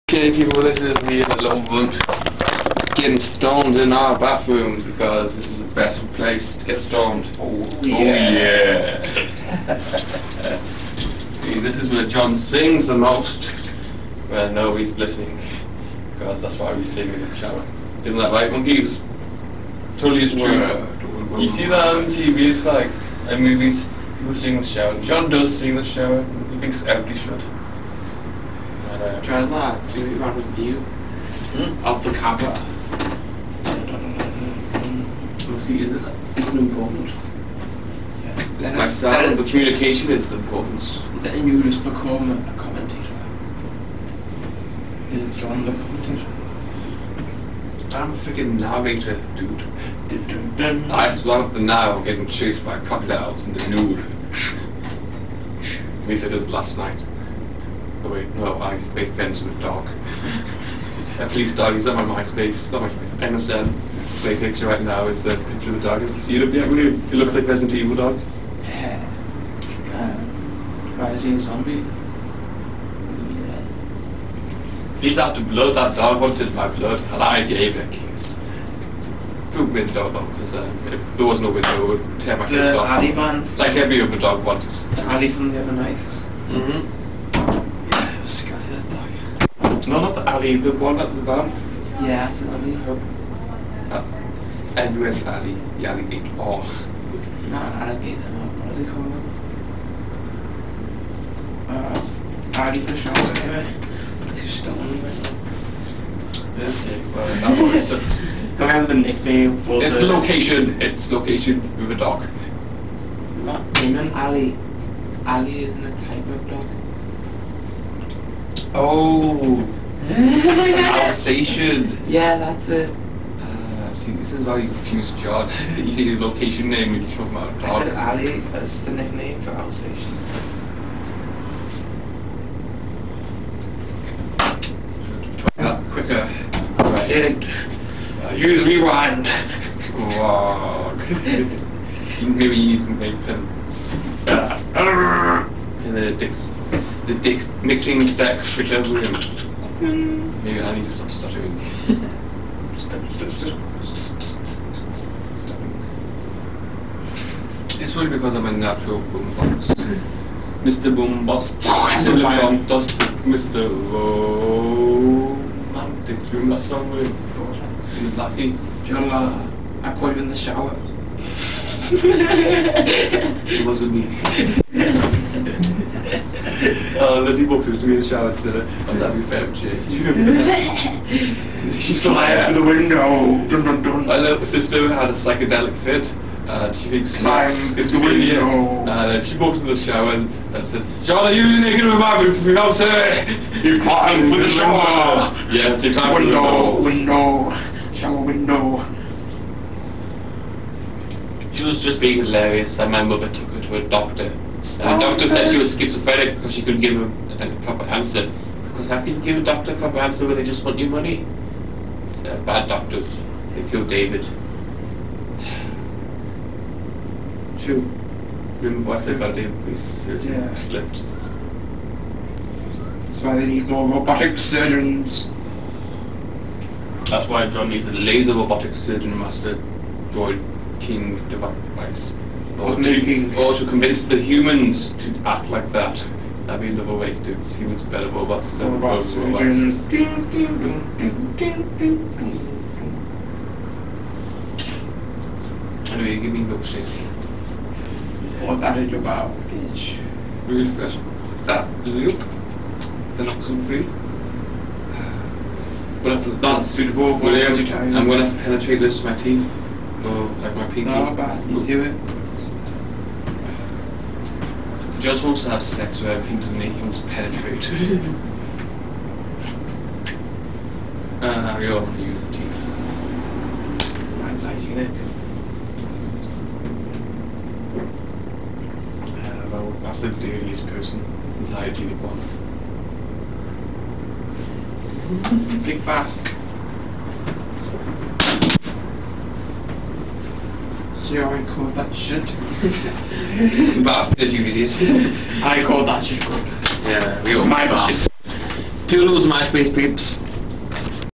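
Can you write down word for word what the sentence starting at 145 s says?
and then it takes the dex, mixing Dex Richard William.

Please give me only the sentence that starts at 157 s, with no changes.
it's really because I'm a natural boombox.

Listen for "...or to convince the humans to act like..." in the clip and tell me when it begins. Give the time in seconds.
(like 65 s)
233 s.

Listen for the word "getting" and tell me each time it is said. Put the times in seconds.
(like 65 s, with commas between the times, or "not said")
2 s, 52 s.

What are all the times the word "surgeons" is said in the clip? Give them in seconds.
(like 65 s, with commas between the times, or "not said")
224 s, 228 s.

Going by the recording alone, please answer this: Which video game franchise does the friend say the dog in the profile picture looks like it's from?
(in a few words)
Resident Evil.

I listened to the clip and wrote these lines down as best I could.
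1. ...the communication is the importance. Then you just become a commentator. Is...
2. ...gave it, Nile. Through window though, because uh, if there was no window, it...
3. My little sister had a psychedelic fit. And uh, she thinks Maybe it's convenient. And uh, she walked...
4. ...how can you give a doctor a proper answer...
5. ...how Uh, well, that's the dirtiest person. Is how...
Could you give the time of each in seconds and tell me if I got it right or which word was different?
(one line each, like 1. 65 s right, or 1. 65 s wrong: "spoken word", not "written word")
1. 39 s right
2. 77 s wrong: "Kings", not "Nile"
3. 184 s wrong: "Climb", not "Maybe"
4. 208 s right
5. 279 s right.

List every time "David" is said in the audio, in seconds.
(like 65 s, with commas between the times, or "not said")
213 s, 219 s.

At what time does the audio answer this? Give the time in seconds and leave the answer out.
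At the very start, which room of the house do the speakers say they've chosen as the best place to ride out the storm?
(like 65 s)
4 s.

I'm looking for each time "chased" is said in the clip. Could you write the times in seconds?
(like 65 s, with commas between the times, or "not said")
52 s.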